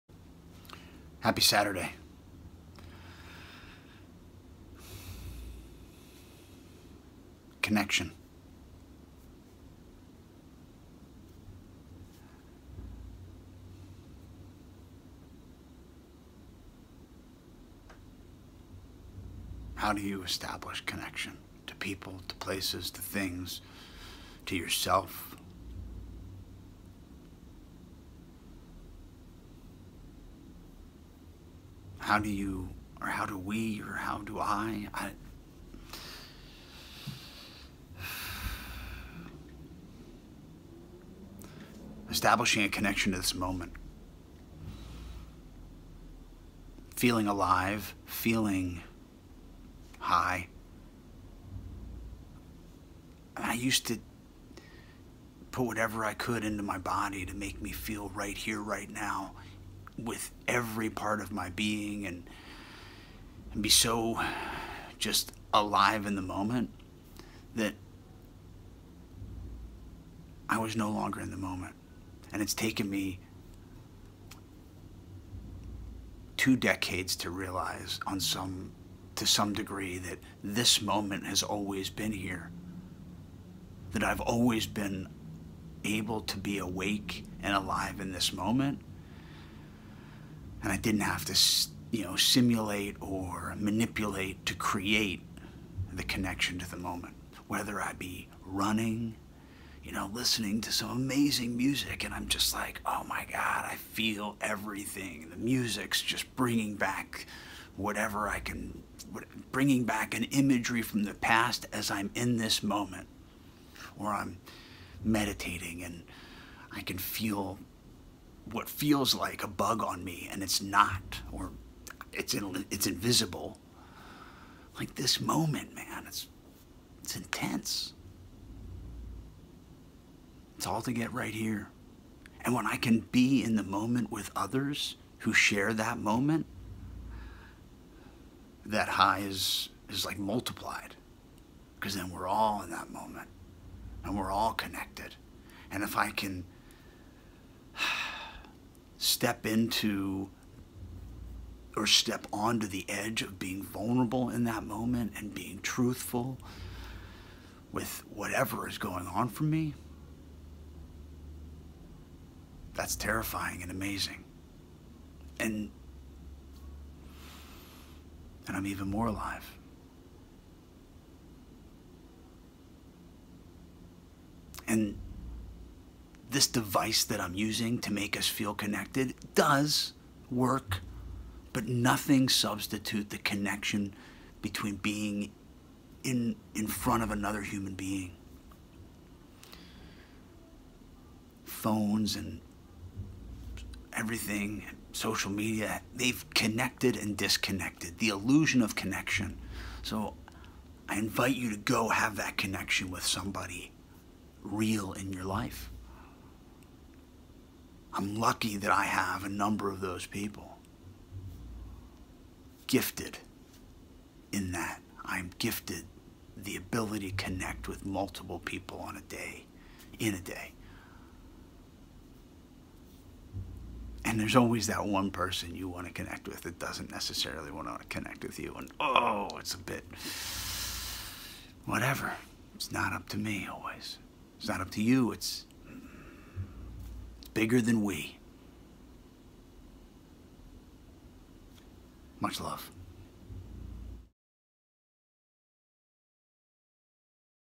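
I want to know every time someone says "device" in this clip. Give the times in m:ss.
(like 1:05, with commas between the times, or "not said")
2:56.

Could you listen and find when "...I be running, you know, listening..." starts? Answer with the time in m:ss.
1:37.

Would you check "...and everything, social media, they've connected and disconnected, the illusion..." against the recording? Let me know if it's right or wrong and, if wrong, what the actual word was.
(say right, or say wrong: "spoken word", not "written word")
right.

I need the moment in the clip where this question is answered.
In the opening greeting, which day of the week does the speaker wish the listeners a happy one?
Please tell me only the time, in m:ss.
0:01.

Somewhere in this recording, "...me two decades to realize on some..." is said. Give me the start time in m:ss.
1:12.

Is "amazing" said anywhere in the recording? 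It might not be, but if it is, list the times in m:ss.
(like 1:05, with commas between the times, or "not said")
1:40, 2:43.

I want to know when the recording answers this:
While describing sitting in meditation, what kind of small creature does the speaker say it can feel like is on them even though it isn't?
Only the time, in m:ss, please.
1:59.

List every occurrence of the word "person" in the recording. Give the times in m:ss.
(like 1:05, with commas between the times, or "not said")
3:45.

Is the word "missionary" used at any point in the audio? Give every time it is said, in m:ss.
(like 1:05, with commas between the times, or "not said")
not said.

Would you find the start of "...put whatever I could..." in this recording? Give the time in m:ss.
0:55.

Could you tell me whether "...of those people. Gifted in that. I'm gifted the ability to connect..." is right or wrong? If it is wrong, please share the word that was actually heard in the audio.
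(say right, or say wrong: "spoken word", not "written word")
right.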